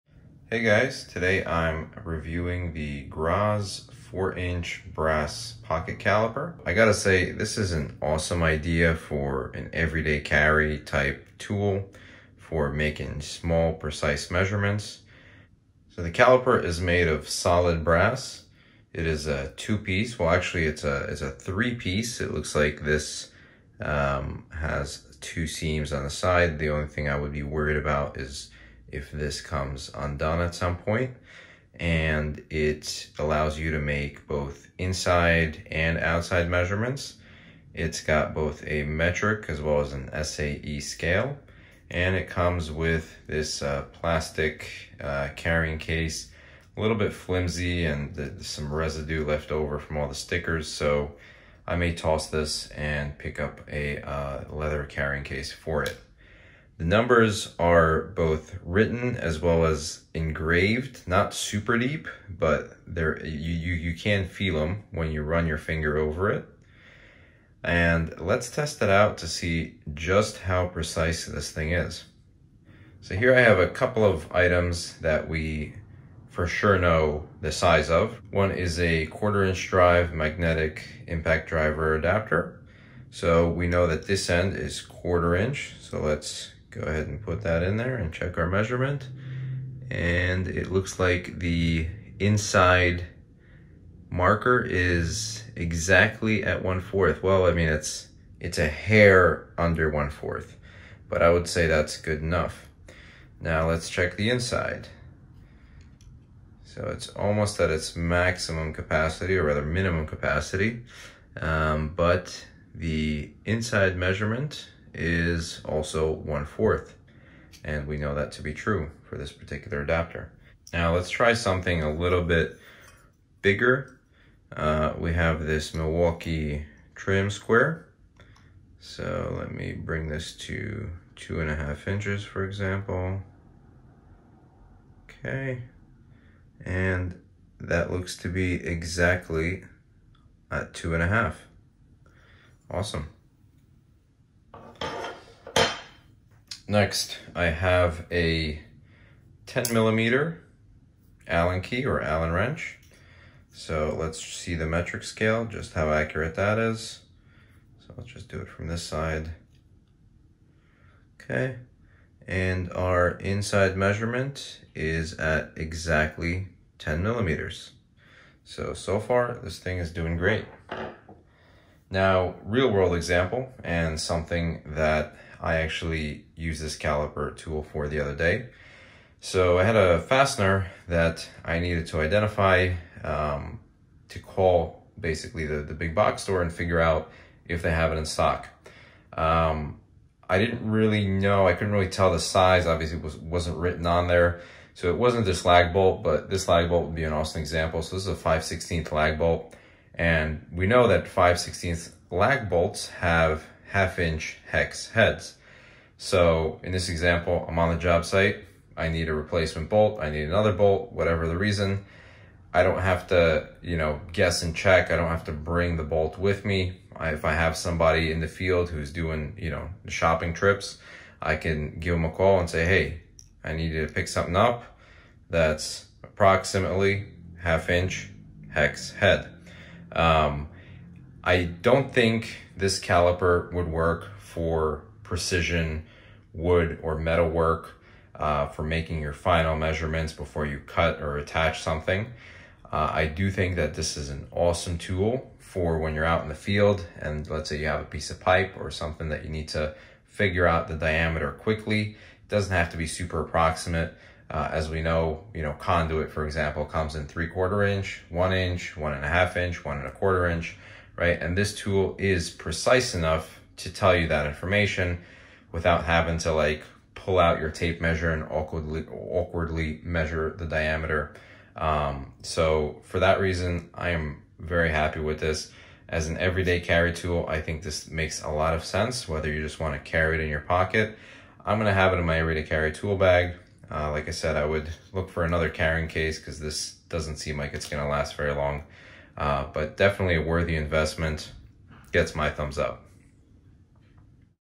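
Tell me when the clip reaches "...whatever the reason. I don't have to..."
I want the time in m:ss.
3:30.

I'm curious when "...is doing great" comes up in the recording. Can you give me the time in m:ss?
2:49.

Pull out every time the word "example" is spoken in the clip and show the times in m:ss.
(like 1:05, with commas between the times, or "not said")
2:12, 2:52, 3:17, 3:26, 4:16.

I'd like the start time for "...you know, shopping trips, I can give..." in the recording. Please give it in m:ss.
3:39.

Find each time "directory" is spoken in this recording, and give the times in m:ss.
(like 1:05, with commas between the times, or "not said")
not said.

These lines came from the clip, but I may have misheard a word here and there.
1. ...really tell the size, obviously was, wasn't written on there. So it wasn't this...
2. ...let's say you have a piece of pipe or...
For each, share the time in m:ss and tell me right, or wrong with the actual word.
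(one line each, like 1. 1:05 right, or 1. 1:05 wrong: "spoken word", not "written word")
1. 3:11 right
2. 4:07 right.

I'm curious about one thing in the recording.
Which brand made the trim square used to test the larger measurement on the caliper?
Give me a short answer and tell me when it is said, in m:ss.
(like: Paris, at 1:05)
Milwaukee, at 2:05.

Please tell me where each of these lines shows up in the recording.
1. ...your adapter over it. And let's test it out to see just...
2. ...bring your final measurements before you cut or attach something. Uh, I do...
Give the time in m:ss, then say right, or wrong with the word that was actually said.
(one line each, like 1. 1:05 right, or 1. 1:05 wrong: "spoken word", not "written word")
1. 1:05 wrong: "finger", not "adapter"
2. 3:58 wrong: "making", not "bring".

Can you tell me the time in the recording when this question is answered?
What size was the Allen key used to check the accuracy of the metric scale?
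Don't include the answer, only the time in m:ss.
2:29.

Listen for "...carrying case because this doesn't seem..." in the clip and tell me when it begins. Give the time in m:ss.
4:45.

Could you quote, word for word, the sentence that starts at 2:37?
So let's just do it from this side.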